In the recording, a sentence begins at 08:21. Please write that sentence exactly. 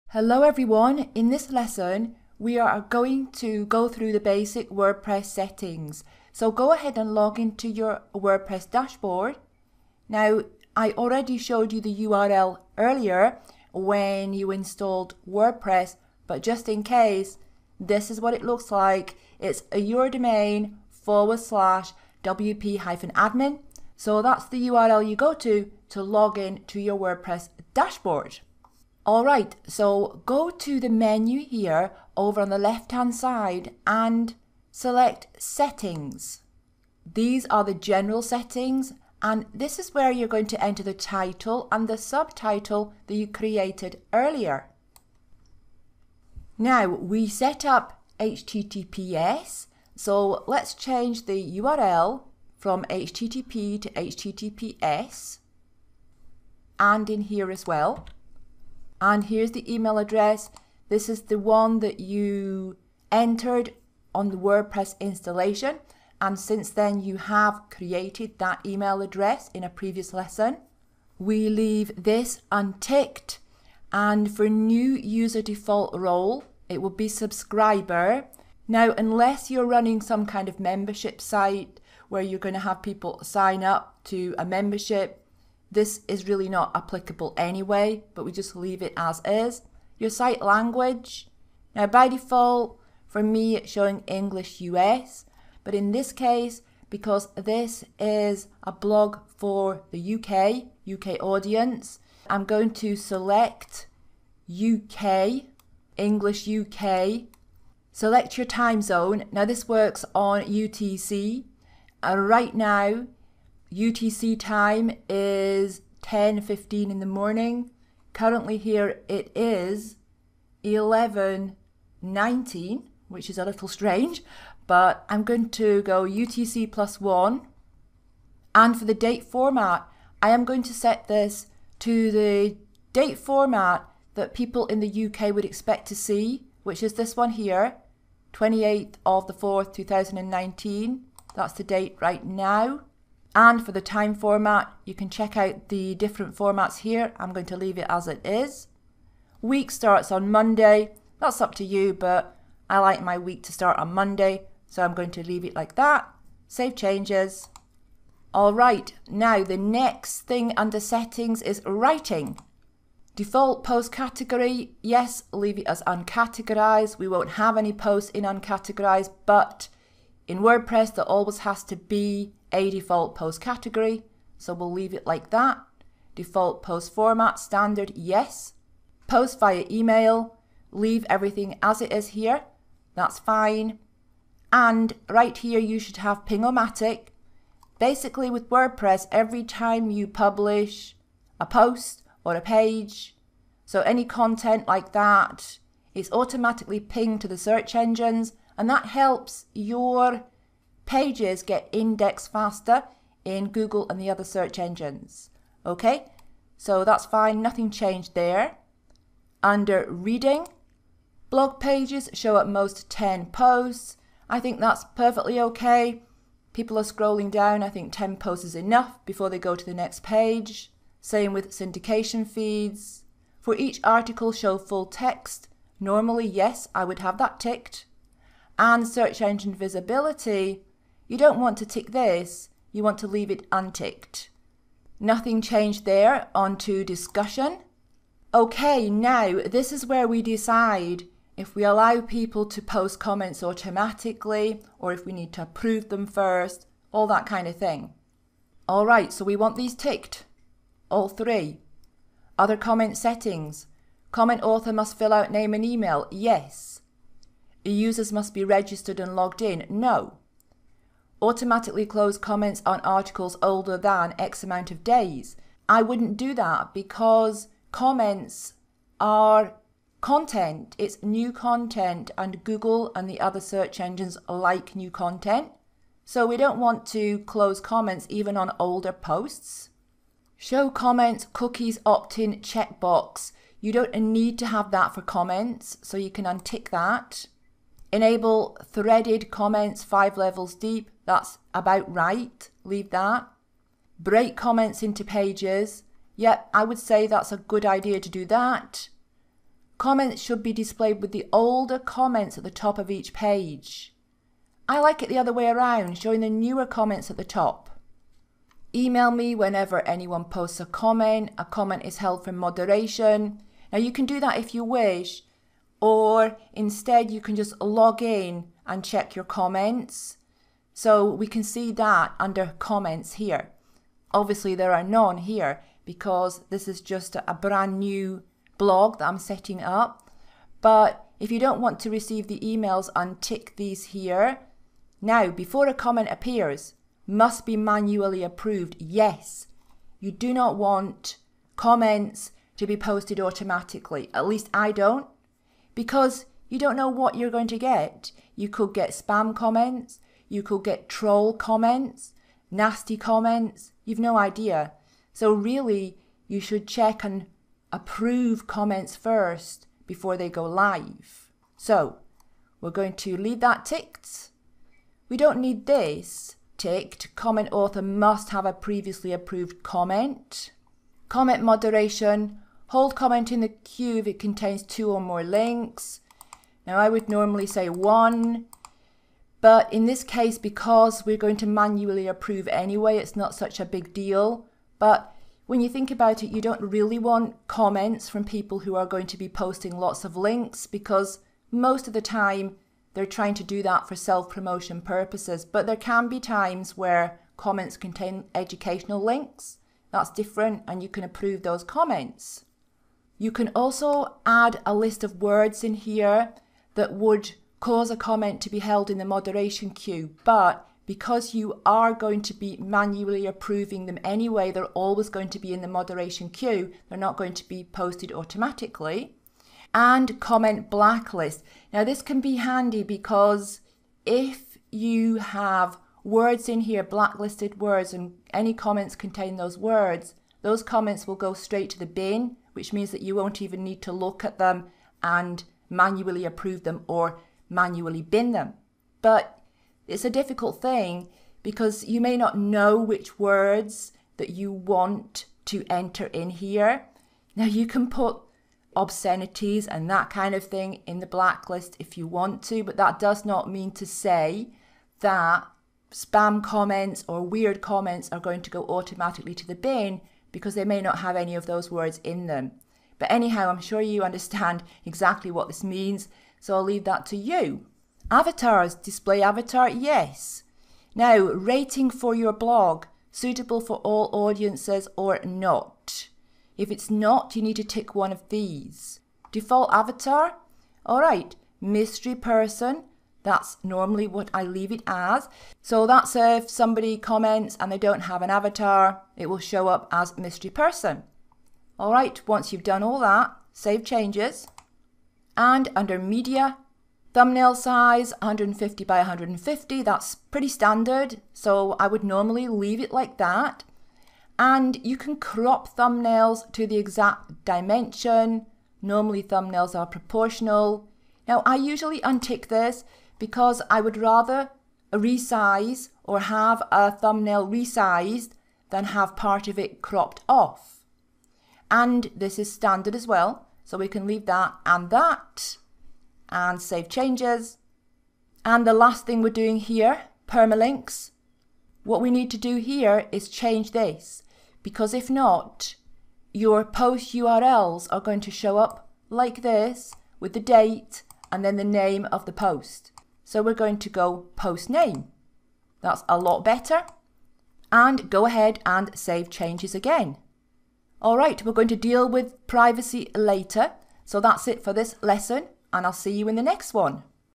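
So I would normally leave it like that.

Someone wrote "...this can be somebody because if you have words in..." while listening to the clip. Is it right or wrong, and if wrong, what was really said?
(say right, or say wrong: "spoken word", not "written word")
wrong: "handy", not "somebody".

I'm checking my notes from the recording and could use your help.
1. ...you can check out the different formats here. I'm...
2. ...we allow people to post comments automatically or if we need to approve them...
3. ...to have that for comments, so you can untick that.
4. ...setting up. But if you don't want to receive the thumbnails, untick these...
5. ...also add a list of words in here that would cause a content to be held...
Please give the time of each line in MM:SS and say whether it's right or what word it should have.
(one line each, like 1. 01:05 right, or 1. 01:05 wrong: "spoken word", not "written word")
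1. 02:24 right
2. 04:01 right
3. 04:44 right
4. 05:29 wrong: "emails", not "thumbnails"
5. 06:43 wrong: "comment", not "content".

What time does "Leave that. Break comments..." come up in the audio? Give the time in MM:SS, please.
04:52.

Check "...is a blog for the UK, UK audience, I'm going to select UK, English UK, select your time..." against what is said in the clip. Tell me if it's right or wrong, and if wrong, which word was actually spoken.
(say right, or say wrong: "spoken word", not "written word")
right.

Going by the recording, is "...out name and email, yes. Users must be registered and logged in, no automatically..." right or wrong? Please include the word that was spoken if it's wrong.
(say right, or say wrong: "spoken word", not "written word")
right.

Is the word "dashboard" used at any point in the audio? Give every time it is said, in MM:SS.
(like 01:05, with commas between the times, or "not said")
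00:08, 00:27.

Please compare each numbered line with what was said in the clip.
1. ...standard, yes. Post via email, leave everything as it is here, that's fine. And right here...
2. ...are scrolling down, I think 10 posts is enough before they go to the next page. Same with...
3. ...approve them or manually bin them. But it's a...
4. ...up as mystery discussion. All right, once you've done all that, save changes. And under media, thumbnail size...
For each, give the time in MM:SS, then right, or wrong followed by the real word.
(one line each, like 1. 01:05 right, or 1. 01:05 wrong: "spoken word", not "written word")
1. 02:57 right
2. 03:36 right
3. 07:16 right
4. 08:09 wrong: "person", not "discussion".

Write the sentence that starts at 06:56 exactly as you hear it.
They're not going to be posted automatically.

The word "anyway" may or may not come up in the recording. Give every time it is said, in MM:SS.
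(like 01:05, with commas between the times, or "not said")
01:27, 06:22, 06:54.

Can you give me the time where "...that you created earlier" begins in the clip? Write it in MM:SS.
00:43.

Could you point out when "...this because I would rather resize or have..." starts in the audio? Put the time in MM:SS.
08:32.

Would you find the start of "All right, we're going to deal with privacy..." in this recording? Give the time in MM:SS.
09:11.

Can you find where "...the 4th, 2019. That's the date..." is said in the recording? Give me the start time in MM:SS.
02:19.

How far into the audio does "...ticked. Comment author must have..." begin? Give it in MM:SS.
06:06.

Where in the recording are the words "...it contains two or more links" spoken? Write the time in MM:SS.
06:14.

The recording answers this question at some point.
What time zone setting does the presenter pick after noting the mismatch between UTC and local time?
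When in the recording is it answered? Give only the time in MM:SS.
02:06.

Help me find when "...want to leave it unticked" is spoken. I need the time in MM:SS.
03:52.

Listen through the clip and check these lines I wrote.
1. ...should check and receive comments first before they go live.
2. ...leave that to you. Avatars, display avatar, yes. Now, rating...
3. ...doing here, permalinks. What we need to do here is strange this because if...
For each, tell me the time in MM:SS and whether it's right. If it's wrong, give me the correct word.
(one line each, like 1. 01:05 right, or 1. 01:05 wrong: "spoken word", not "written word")
1. 05:56 wrong: "approve", not "receive"
2. 07:46 right
3. 08:49 wrong: "change", not "strange".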